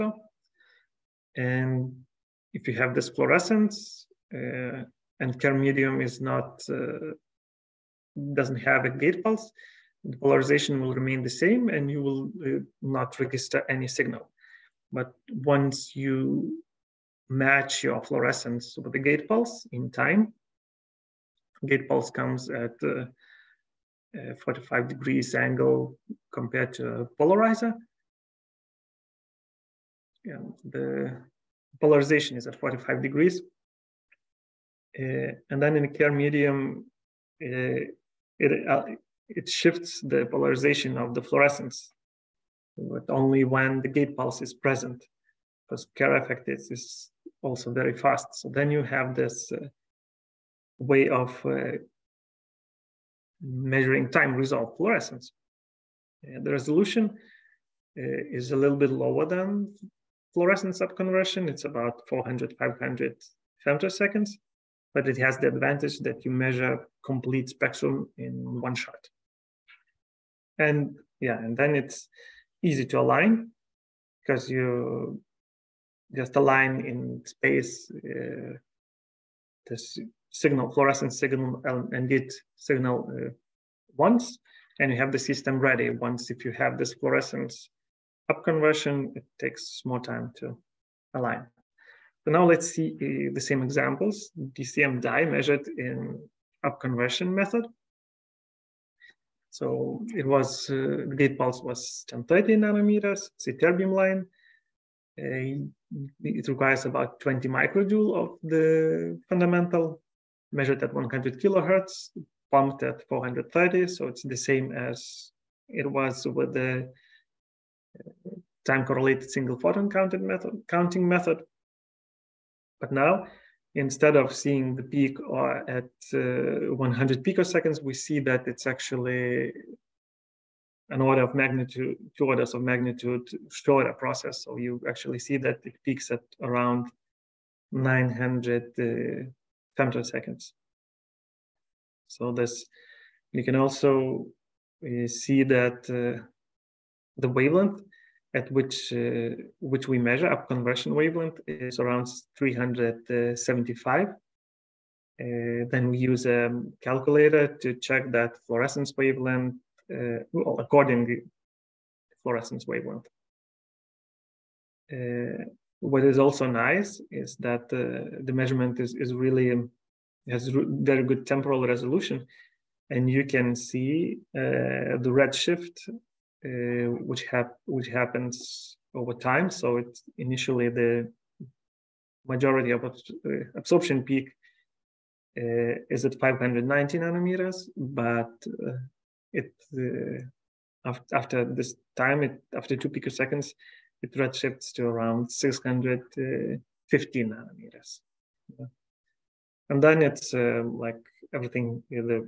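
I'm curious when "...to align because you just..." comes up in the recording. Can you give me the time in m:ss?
1:12.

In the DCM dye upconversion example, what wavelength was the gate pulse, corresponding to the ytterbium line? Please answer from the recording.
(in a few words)
1030 nanometers.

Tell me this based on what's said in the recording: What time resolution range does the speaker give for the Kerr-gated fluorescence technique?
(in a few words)
400-500 femtoseconds.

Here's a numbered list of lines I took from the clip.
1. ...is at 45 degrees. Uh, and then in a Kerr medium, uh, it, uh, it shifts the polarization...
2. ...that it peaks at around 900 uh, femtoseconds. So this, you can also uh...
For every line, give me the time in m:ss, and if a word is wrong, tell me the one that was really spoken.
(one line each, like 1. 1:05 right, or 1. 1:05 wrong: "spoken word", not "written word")
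1. 0:32 right
2. 2:15 right.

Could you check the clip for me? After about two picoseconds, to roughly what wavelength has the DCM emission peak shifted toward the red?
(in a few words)
650 nanometers.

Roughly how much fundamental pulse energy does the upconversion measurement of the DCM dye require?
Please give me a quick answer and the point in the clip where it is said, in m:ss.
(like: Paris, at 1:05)
20 microjoules, at 1:47.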